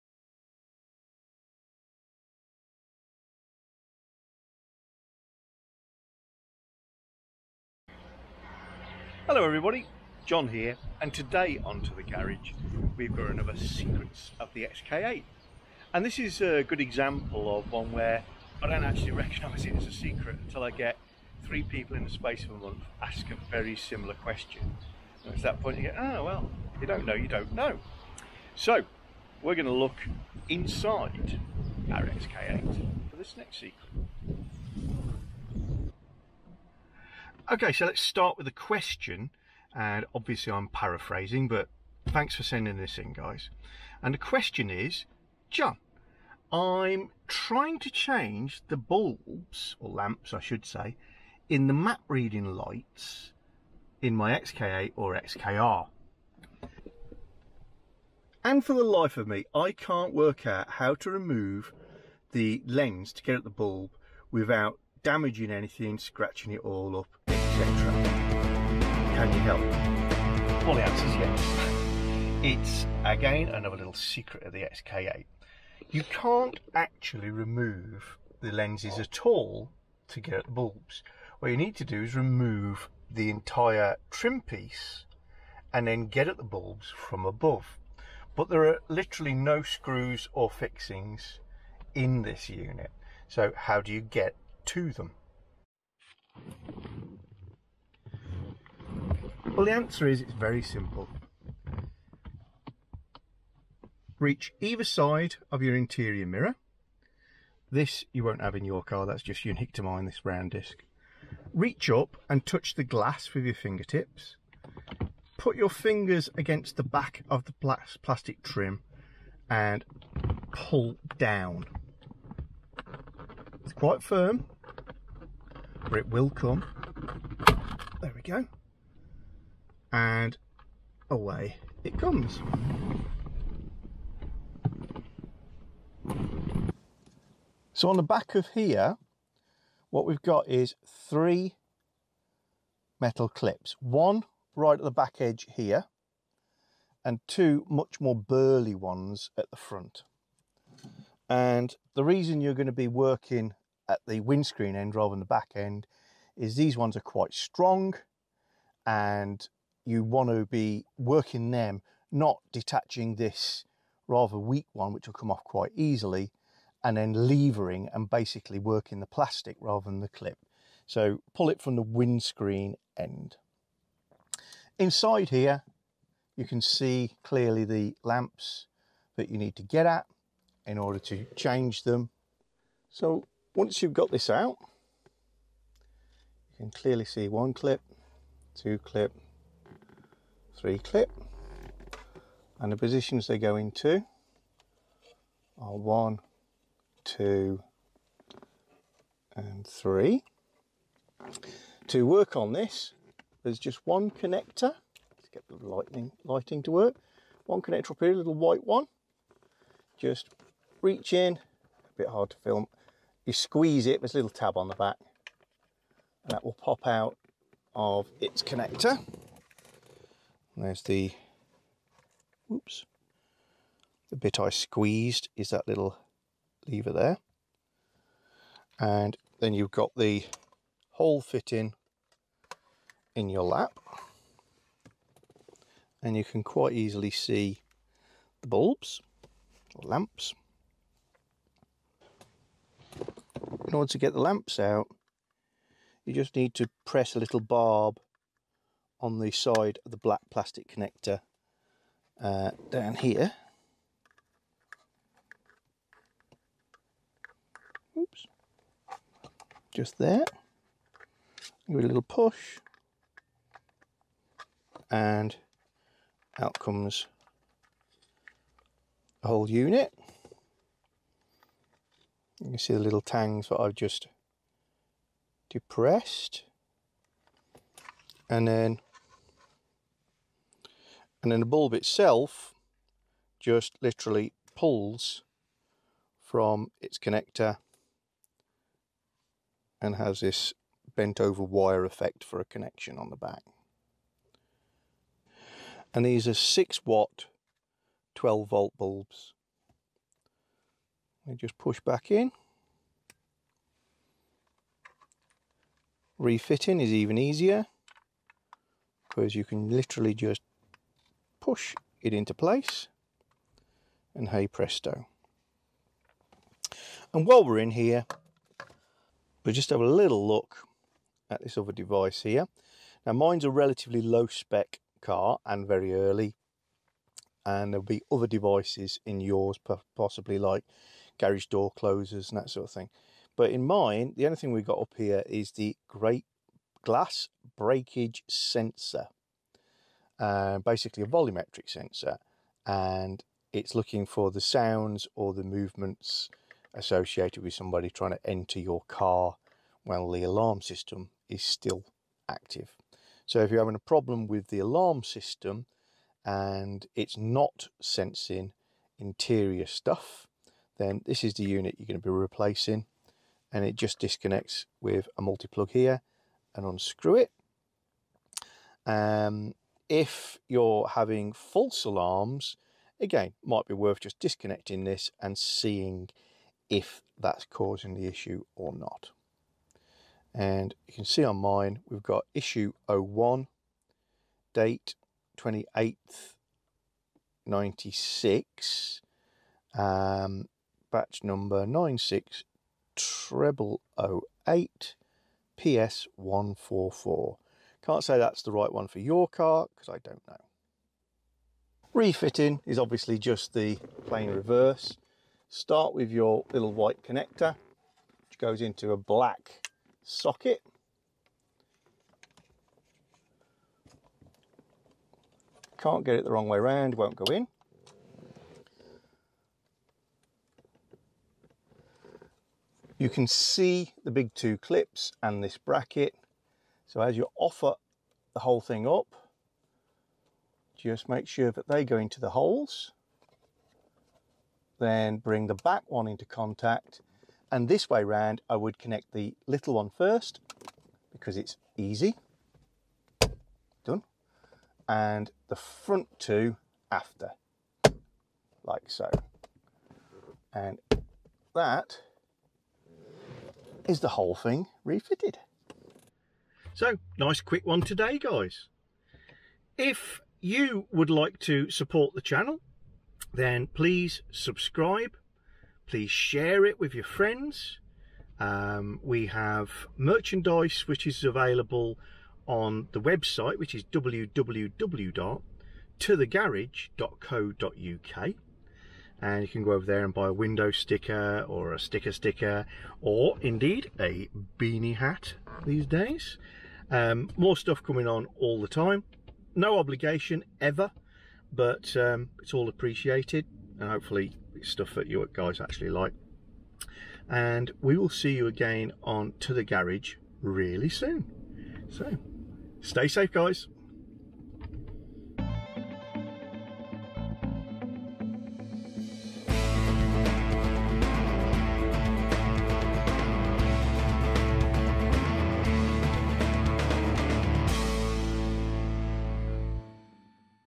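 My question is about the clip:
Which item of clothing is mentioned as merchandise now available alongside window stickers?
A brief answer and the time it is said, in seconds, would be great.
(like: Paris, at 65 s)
Beanie hat, at 484 s.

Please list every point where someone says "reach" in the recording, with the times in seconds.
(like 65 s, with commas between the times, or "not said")
104 s, 111 s, 210 s.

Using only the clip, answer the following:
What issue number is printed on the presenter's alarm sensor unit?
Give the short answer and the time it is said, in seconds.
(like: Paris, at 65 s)
01, at 382 s.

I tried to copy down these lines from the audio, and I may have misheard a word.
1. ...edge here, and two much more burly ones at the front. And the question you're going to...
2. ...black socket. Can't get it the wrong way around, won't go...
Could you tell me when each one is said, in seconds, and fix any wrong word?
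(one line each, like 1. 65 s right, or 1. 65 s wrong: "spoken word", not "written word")
1. 145 s wrong: "reason", not "question"
2. 408 s right.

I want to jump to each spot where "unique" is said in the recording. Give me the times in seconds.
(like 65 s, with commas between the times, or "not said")
109 s.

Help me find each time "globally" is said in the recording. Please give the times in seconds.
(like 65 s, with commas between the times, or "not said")
not said.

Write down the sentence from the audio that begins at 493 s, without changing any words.
And hopefully it's stuff that you guys actually like.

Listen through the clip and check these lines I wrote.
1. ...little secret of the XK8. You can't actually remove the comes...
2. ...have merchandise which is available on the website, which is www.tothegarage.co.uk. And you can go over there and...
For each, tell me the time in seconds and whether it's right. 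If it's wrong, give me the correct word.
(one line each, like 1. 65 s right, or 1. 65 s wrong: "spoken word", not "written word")
1. 73 s wrong: "lenses", not "comes"
2. 469 s right.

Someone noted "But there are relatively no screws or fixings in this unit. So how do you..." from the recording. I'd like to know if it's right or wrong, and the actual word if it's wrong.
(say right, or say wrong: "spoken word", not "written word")
wrong: "literally", not "relatively".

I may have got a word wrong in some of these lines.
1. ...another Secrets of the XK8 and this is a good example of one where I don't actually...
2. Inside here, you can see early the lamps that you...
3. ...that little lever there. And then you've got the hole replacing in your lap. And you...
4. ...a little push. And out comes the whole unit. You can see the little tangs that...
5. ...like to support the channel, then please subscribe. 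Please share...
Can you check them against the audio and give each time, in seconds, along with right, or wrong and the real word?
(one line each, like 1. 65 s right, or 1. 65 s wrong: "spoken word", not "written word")
1. 13 s right
2. 174 s wrong: "clearly", not "early"
3. 225 s wrong: "fitting", not "replacing"
4. 261 s right
5. 461 s right.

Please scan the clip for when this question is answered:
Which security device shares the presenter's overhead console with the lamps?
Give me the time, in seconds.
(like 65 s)
336 s.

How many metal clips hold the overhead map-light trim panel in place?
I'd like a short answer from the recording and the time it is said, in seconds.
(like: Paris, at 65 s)
3, at 140 s.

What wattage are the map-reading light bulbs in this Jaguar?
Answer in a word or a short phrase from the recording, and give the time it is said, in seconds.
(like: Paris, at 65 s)
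6 watt, at 296 s.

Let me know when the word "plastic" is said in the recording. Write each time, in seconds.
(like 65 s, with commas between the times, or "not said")
118 s, 169 s, 250 s.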